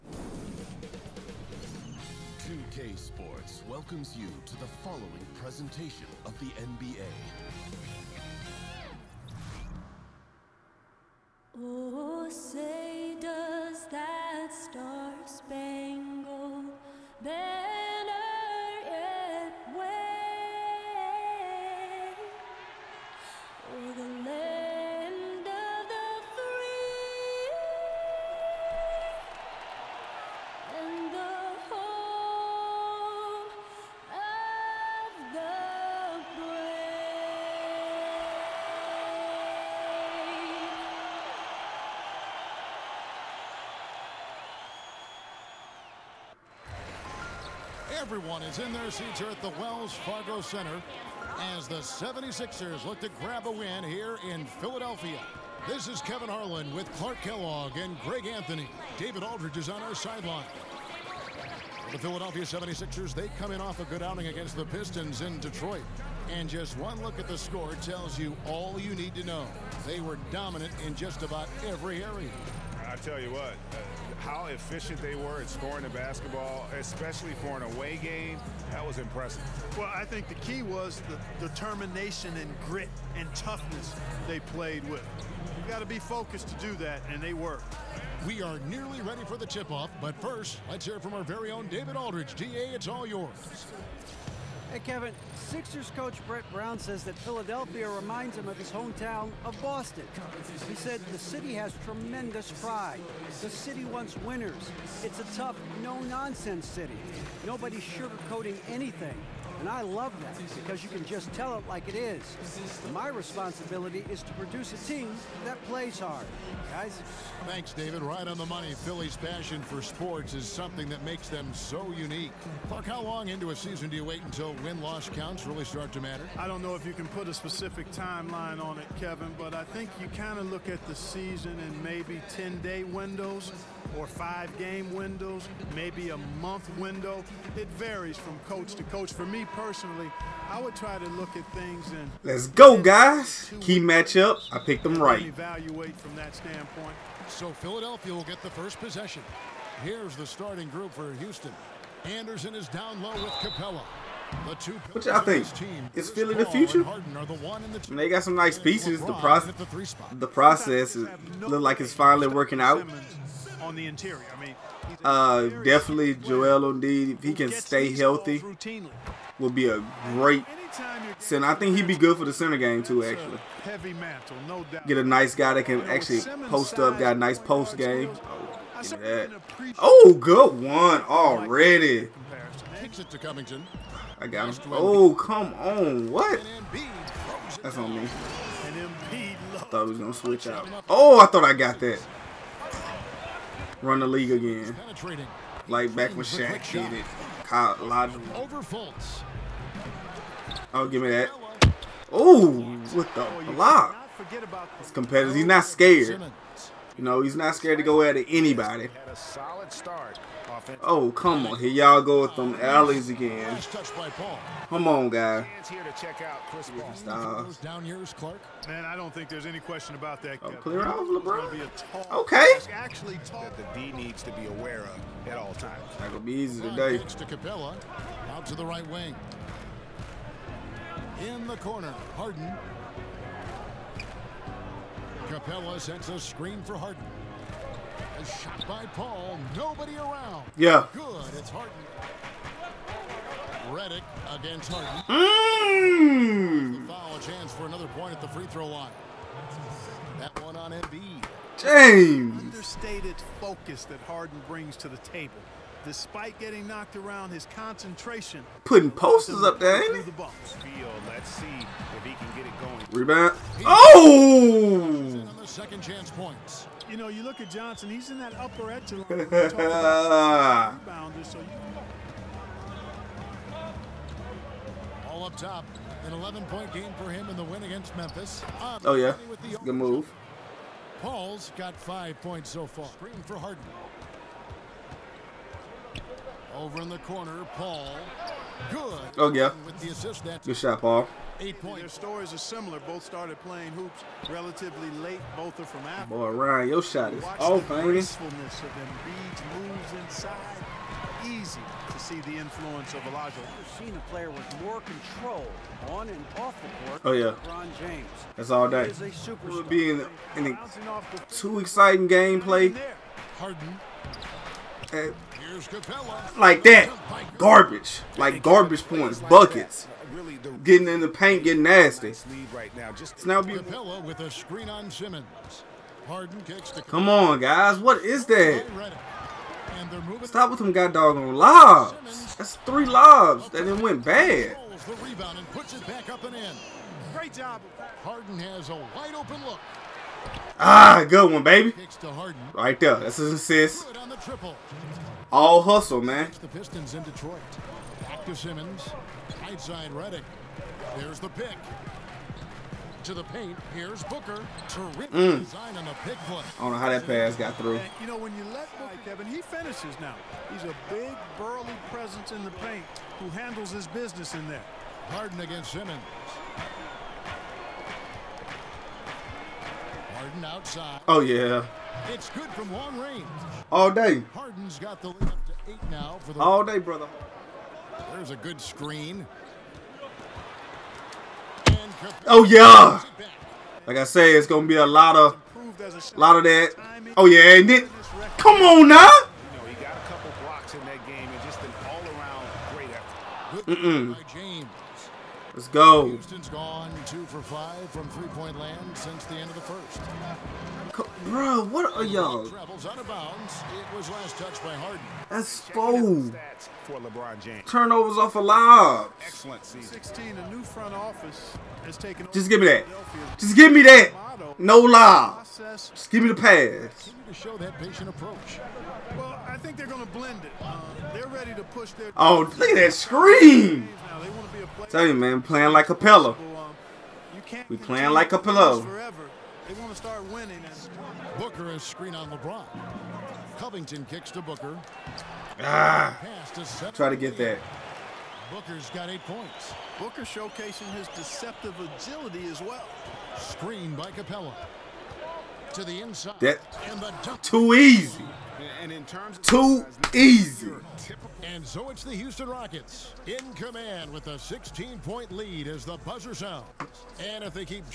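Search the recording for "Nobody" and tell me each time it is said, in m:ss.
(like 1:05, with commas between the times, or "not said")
1:47, 3:59.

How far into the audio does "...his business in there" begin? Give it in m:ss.
6:03.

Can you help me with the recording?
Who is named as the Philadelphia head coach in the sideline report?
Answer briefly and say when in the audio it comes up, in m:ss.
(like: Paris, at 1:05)
Brett Brown, at 1:36.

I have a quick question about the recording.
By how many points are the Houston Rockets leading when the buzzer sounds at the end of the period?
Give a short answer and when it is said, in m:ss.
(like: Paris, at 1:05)
16, at 7:34.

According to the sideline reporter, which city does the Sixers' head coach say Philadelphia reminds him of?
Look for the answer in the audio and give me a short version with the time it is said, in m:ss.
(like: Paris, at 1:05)
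Boston, at 1:39.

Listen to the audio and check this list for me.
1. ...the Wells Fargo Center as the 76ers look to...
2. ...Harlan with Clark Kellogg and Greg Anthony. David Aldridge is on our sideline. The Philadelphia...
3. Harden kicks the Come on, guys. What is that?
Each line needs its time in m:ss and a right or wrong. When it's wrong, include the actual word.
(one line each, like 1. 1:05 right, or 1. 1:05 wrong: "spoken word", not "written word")
1. 0:49 right
2. 0:56 right
3. 5:26 right.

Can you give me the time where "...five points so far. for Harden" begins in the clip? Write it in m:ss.
4:41.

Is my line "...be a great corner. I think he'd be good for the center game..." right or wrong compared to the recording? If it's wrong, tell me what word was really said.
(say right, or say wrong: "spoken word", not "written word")
wrong: "center", not "corner".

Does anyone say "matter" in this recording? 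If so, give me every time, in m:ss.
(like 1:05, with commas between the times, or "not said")
2:06.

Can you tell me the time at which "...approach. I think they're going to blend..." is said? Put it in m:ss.
6:58.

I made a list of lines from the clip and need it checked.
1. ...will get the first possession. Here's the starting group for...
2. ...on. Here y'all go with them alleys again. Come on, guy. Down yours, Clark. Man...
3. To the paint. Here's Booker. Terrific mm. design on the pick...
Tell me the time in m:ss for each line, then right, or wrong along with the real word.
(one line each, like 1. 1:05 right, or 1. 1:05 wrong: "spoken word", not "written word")
1. 2:28 right
2. 3:31 right
3. 5:53 right.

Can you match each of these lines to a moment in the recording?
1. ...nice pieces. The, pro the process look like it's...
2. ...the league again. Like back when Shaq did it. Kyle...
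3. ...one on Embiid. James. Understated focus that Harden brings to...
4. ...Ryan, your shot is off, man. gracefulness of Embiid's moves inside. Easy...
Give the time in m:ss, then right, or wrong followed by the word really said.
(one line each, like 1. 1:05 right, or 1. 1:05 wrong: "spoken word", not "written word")
1. 2:38 right
2. 3:14 right
3. 4:10 right
4. 4:56 right.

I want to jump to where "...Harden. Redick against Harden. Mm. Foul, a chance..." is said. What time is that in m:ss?
4:01.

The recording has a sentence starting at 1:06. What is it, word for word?
And just one look at the score tells you all you need to know.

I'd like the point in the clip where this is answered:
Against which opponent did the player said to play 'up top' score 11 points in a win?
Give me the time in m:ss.
4:37.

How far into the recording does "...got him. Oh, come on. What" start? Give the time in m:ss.
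3:04.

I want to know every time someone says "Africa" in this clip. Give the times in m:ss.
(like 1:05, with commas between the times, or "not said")
4:55.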